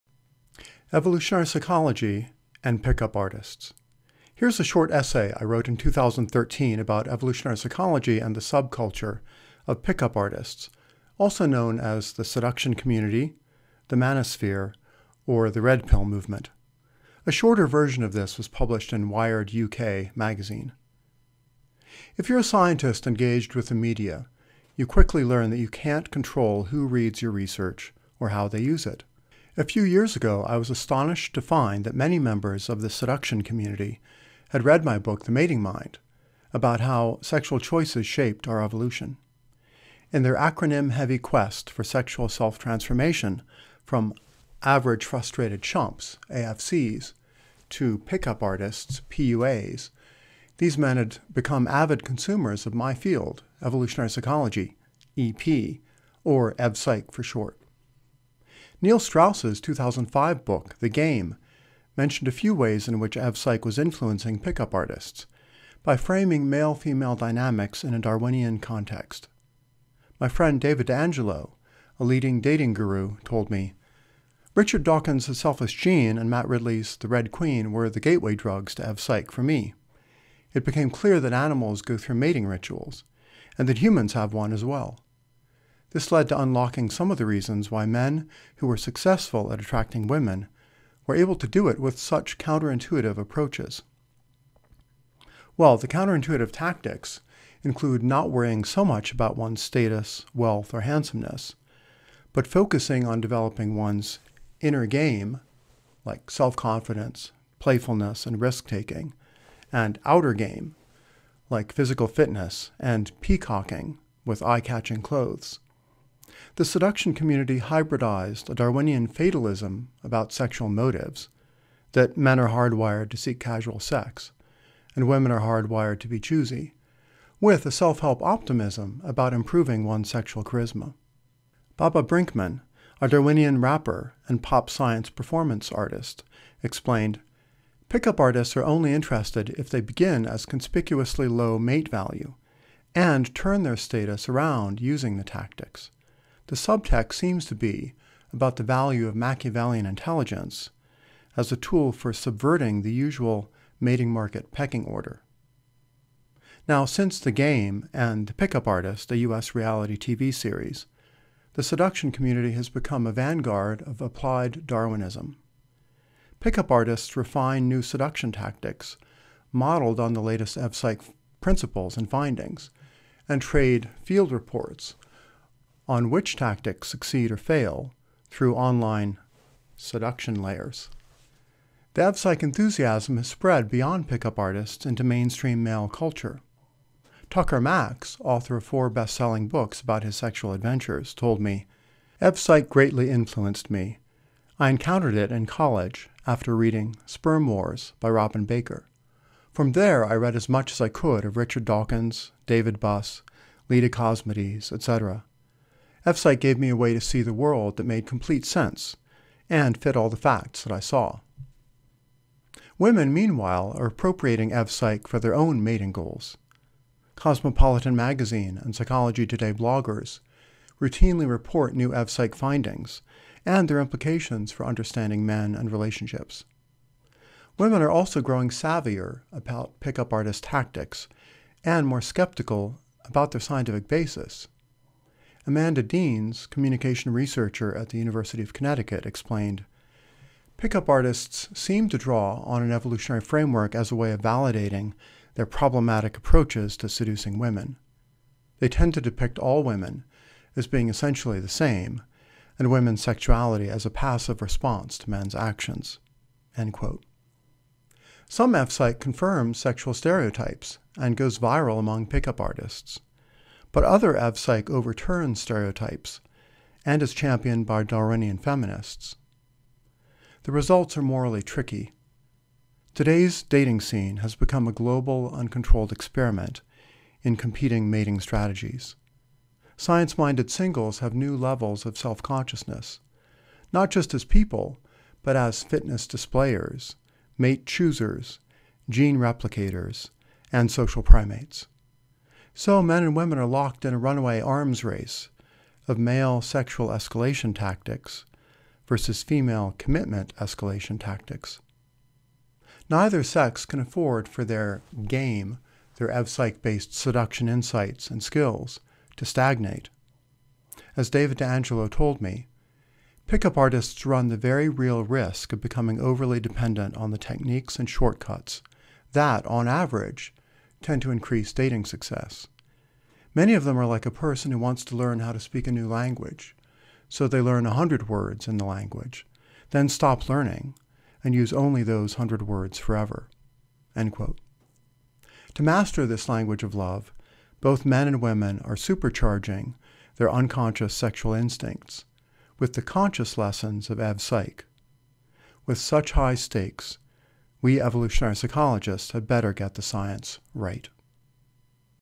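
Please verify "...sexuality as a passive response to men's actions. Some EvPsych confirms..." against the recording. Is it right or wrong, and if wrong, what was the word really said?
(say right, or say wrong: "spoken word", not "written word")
right.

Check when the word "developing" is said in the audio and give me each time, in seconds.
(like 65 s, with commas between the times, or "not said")
103 s.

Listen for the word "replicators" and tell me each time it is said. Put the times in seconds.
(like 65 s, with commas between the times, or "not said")
289 s.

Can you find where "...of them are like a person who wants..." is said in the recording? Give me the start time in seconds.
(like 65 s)
323 s.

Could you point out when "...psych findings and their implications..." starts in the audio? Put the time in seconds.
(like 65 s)
222 s.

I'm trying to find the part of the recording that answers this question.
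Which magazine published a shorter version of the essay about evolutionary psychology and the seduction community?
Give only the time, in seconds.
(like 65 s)
19 s.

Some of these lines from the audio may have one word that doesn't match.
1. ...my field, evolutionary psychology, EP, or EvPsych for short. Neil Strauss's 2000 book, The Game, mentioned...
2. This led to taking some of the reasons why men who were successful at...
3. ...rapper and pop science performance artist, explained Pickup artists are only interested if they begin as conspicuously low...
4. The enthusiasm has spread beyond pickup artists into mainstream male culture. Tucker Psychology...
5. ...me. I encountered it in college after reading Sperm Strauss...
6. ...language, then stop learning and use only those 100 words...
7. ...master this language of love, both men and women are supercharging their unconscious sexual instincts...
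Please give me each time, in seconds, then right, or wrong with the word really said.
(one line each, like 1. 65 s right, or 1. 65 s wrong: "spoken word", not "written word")
1. 52 s wrong: "2005", not "2000"
2. 85 s wrong: "unlocking", not "taking"
3. 133 s right
4. 181 s wrong: "Max", not "Psychology"
5. 193 s wrong: "Wars", not "Strauss"
6. 328 s right
7. 335 s right.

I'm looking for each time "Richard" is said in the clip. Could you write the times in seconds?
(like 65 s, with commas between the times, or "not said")
74 s, 201 s.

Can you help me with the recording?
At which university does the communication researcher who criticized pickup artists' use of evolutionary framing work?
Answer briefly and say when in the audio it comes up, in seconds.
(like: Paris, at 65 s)
University of Connecticut, at 237 s.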